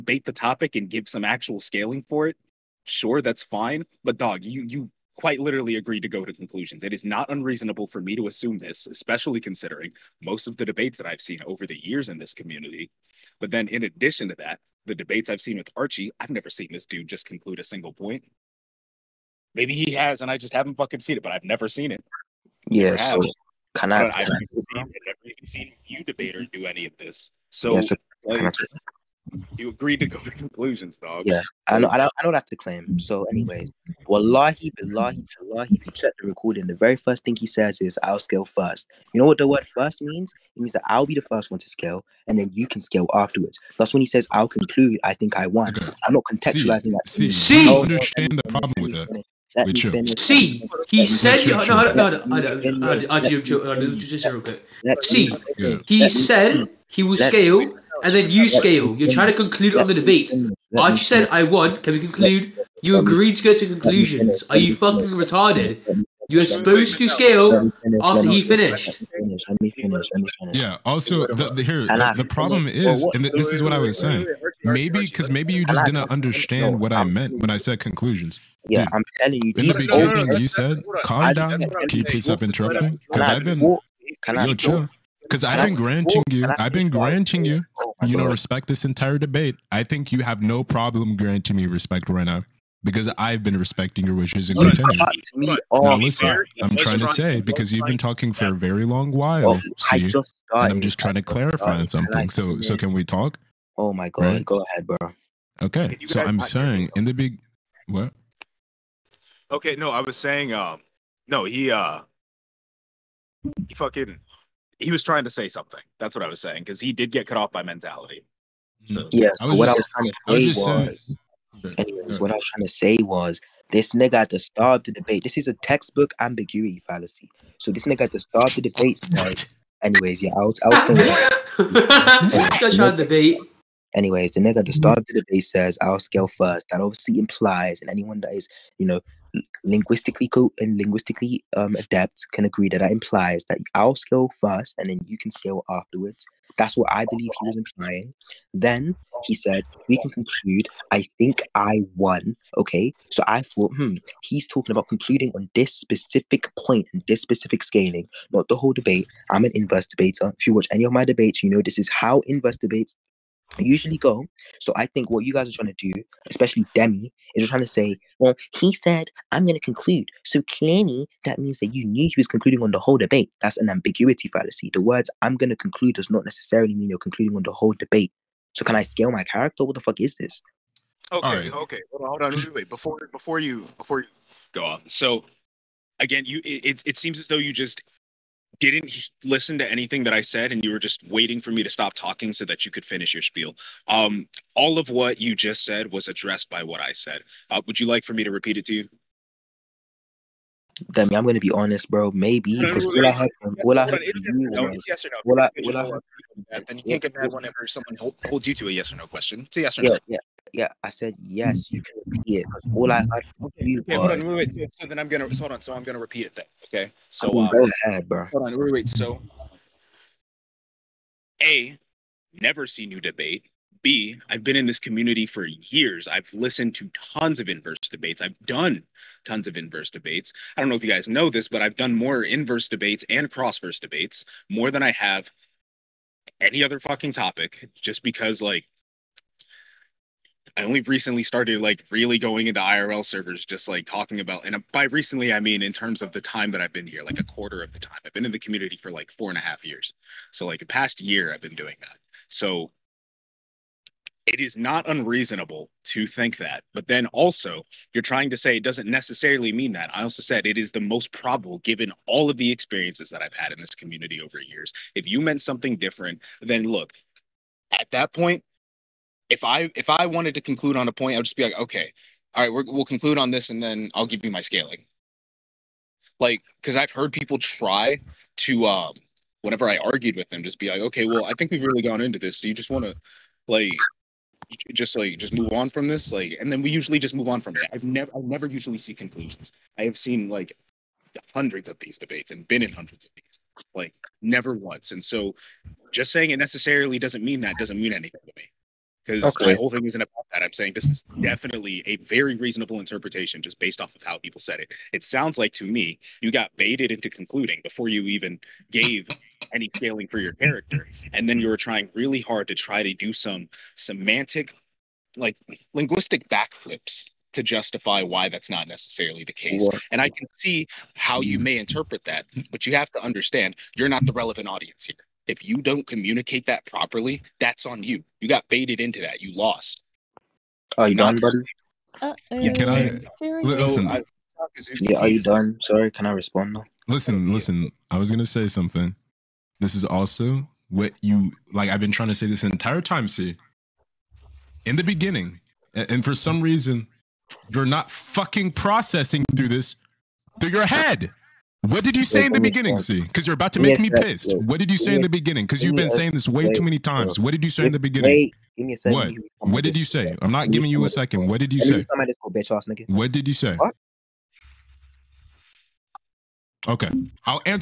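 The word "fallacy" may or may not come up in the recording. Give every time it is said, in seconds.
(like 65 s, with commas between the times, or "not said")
126 s, 174 s.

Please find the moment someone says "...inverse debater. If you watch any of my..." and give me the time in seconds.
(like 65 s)
159 s.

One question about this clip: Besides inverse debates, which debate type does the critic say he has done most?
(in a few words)
crossverse debates.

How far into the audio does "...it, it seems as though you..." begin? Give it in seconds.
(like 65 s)
186 s.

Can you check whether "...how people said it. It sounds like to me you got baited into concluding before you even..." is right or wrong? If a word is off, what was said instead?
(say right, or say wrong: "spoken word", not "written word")
right.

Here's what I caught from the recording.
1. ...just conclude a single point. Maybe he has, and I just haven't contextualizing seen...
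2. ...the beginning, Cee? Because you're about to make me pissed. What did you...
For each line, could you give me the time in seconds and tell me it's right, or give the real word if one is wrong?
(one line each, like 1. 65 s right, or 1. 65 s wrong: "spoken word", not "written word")
1. 17 s wrong: "fucking", not "contextualizing"
2. 352 s right.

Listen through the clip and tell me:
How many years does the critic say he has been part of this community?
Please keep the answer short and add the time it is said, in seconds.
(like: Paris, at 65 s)
4.5 years, at 249 s.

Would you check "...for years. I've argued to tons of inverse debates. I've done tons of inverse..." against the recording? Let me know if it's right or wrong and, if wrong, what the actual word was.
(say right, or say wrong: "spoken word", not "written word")
wrong: "listened", not "argued".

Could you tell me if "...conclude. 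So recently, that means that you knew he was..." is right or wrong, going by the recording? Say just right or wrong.
wrong.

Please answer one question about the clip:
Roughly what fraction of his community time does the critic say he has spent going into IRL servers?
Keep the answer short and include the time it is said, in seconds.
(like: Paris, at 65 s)
a quarter, at 247 s.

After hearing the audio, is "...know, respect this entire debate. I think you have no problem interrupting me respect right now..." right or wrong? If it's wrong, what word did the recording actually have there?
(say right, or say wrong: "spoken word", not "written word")
wrong: "granting", not "interrupting".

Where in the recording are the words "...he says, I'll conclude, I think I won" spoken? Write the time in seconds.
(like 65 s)
44 s.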